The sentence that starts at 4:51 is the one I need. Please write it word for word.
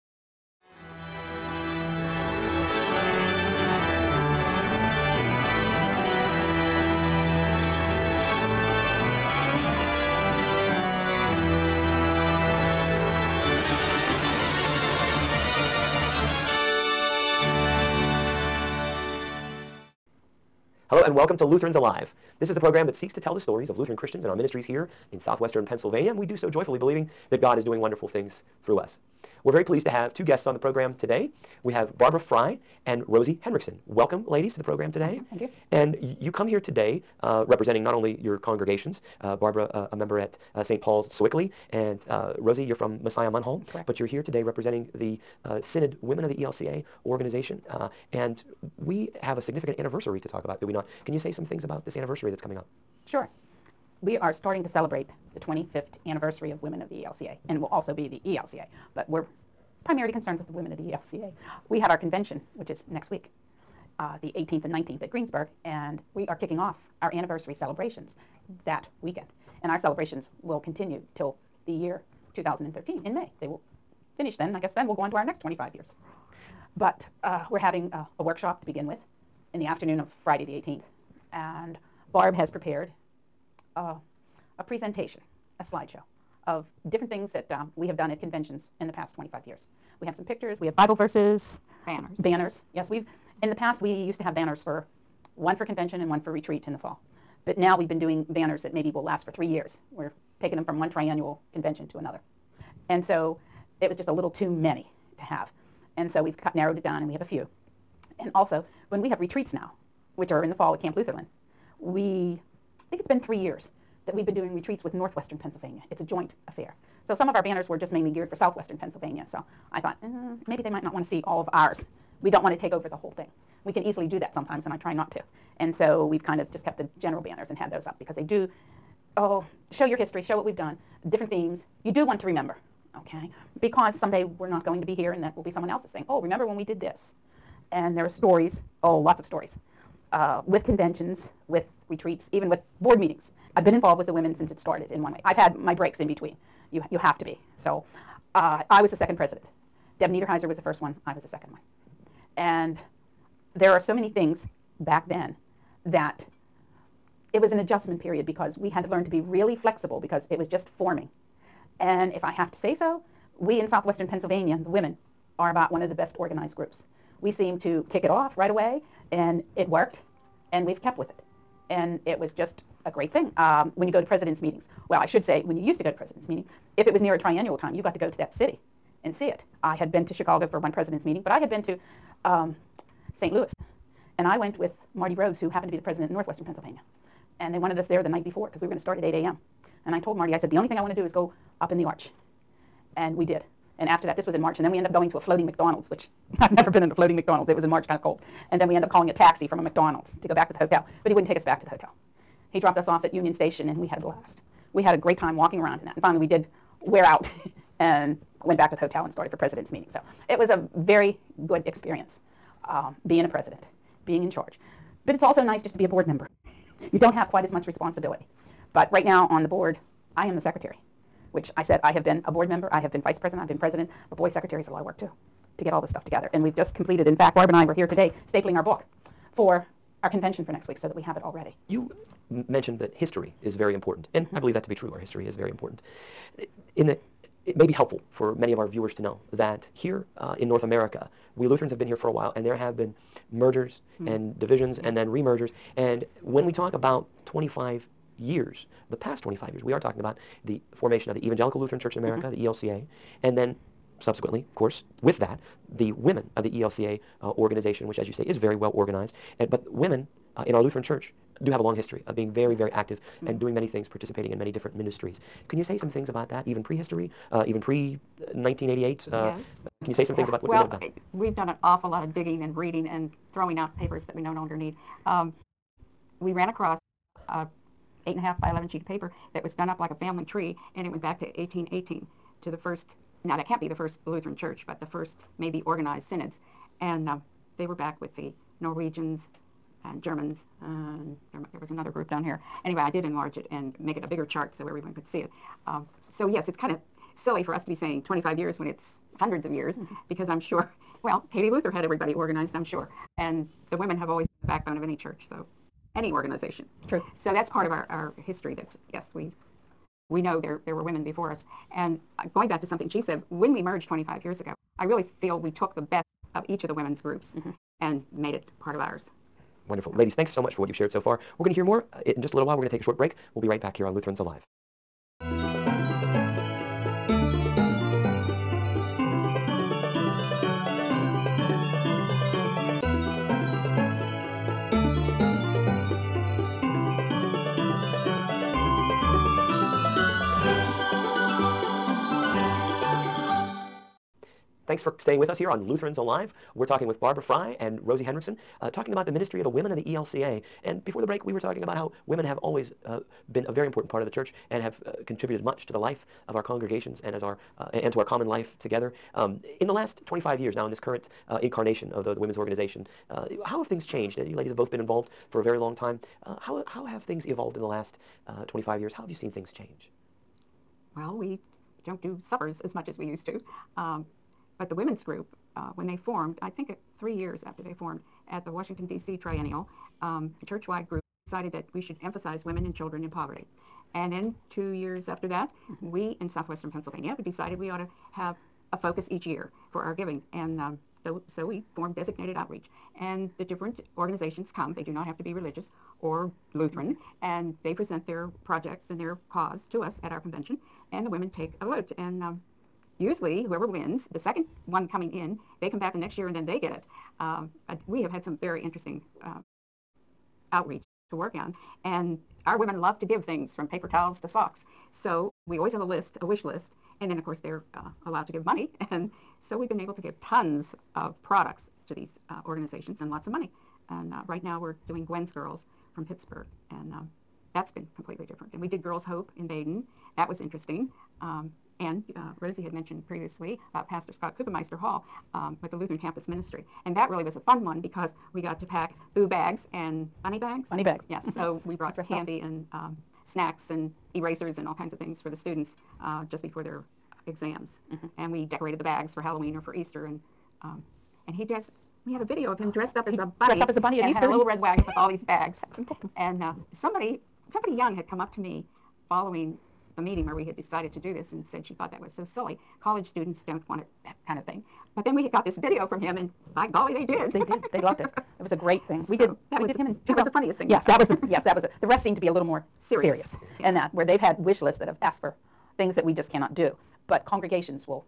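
there, there was another group down here.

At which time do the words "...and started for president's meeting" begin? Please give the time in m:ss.
3:29.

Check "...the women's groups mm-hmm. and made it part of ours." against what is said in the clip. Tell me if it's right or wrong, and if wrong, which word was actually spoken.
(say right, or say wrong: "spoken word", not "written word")
right.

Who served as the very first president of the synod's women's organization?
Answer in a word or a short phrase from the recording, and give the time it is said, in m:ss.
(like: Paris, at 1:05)
Deb Niederheiser, at 2:30.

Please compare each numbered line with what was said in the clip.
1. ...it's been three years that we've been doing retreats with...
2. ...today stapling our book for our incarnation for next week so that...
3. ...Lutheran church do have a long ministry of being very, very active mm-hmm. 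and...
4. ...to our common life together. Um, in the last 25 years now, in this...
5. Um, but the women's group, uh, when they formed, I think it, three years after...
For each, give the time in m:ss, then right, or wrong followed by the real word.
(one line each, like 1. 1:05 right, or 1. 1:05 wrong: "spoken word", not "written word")
1. 1:53 right
2. 3:47 wrong: "convention", not "incarnation"
3. 4:20 wrong: "history", not "ministry"
4. 5:57 right
5. 6:13 right.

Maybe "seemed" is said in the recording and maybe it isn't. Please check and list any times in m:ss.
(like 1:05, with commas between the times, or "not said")
2:47, 7:52.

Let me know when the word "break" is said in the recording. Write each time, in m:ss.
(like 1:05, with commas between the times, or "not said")
2:25, 5:22, 5:51.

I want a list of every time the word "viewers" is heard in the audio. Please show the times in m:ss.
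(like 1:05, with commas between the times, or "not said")
3:58.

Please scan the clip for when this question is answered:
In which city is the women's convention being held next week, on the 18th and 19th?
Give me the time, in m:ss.
1:05.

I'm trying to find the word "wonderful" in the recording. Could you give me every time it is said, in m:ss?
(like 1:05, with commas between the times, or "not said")
0:27, 5:19.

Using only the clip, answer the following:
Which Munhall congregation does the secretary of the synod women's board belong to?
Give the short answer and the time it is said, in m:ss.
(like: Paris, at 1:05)
Messiah, at 0:43.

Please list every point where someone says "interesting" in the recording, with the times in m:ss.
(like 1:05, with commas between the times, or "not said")
6:48, 7:10.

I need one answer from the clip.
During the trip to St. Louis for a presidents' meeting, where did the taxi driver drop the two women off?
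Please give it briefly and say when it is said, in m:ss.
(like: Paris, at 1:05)
Union Station, at 3:23.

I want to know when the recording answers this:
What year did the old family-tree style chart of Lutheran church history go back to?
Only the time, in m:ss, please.
4:41.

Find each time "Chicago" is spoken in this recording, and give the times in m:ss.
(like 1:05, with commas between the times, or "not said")
3:00.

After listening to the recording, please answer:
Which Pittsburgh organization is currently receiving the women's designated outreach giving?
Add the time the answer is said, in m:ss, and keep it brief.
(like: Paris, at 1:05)
Gwen's Girls, at 7:05.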